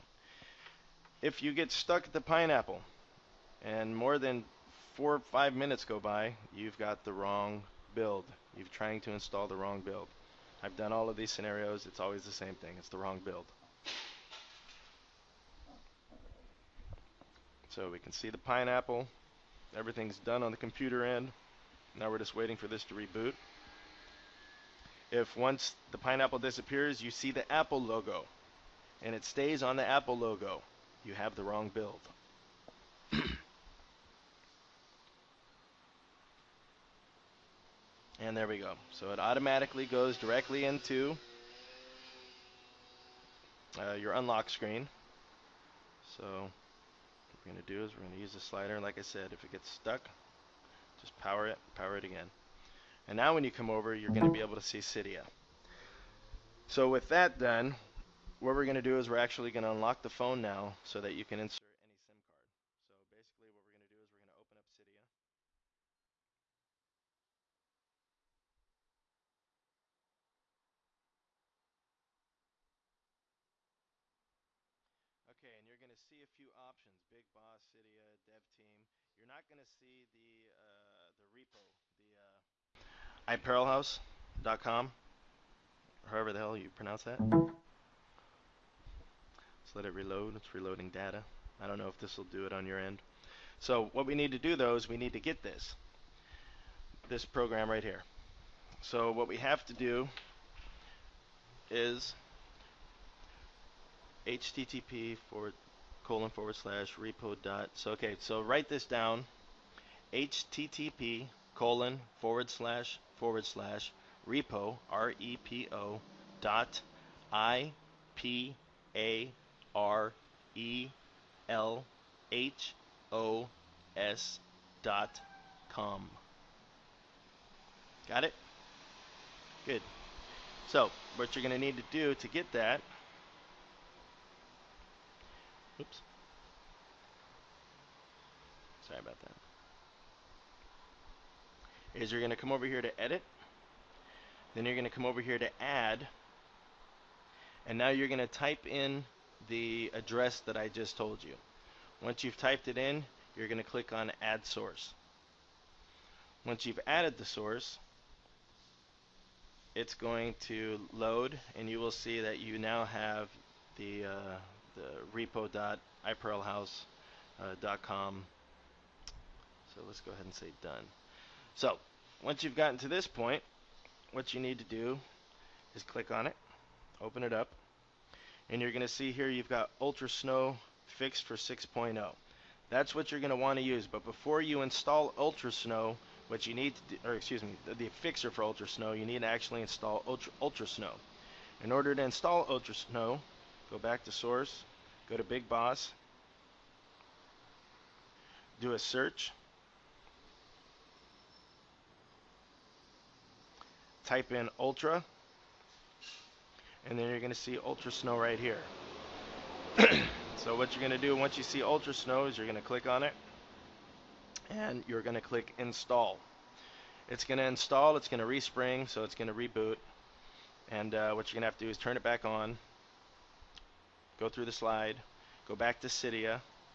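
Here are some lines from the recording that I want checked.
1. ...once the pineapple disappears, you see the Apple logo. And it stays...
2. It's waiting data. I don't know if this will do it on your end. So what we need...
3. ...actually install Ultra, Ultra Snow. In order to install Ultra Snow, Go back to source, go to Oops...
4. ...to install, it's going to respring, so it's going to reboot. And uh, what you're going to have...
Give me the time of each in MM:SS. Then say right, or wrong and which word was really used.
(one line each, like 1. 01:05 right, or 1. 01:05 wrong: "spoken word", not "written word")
1. 00:25 right
2. 01:30 wrong: "reloading", not "waiting"
3. 03:09 wrong: "Big", not "Oops"
4. 03:37 right.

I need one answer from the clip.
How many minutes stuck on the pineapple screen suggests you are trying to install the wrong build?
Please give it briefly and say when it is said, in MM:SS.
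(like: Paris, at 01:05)
4 or 5 minutes, at 00:04.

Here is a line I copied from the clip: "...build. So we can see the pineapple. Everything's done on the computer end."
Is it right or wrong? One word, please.
right.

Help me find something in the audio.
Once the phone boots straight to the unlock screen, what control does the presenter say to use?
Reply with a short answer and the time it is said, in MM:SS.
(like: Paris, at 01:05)
the slider, at 00:48.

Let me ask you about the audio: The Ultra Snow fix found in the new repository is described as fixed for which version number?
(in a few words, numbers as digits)
6.0.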